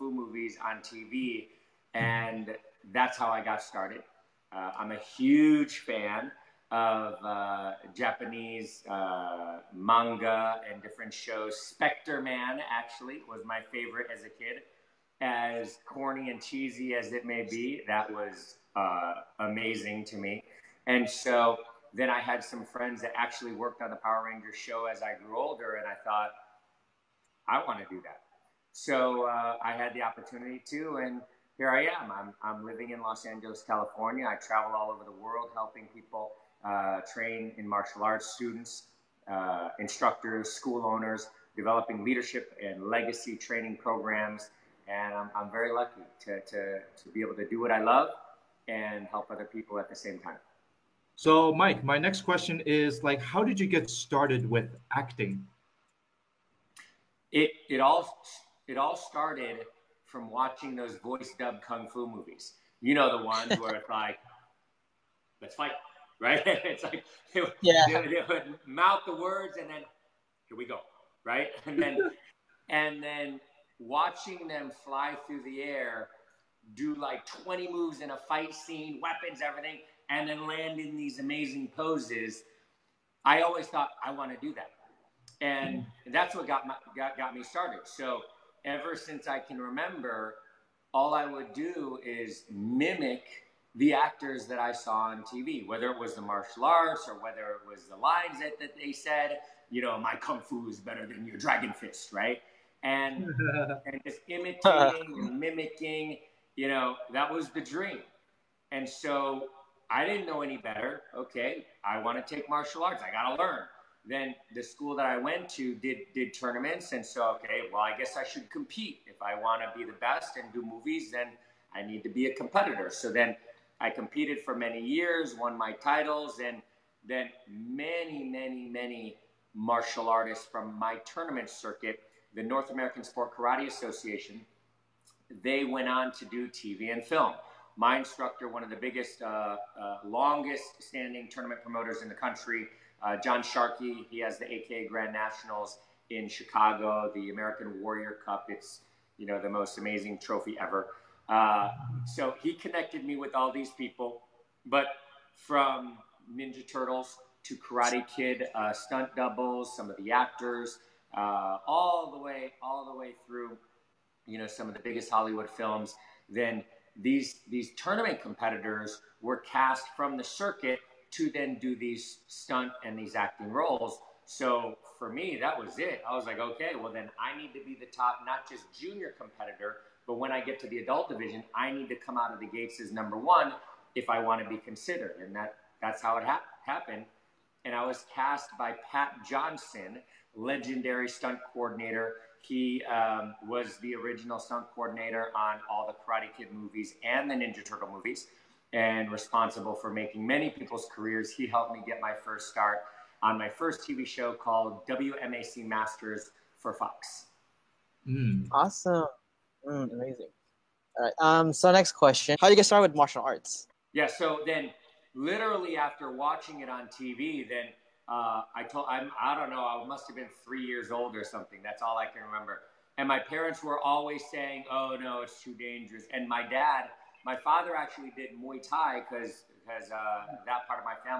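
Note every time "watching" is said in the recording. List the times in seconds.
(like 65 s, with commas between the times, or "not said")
60 s, 73 s, 216 s.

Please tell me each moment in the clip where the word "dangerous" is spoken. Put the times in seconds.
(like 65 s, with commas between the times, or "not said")
225 s.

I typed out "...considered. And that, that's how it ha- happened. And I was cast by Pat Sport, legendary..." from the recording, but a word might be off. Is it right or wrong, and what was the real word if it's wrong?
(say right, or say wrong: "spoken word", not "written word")
wrong: "Johnson", not "Sport".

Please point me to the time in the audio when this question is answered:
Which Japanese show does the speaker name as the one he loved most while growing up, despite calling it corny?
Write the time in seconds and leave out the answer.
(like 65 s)
11 s.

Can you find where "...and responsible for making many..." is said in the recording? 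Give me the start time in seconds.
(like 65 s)
198 s.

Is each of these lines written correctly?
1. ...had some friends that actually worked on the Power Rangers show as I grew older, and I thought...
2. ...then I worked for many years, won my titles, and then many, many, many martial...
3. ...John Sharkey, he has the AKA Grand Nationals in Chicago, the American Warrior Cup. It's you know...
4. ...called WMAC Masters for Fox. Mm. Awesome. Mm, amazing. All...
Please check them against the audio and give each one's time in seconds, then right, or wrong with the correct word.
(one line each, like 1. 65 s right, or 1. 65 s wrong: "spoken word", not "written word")
1. 22 s right
2. 123 s wrong: "competed", not "worked"
3. 143 s right
4. 204 s right.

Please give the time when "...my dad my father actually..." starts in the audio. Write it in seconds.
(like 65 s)
226 s.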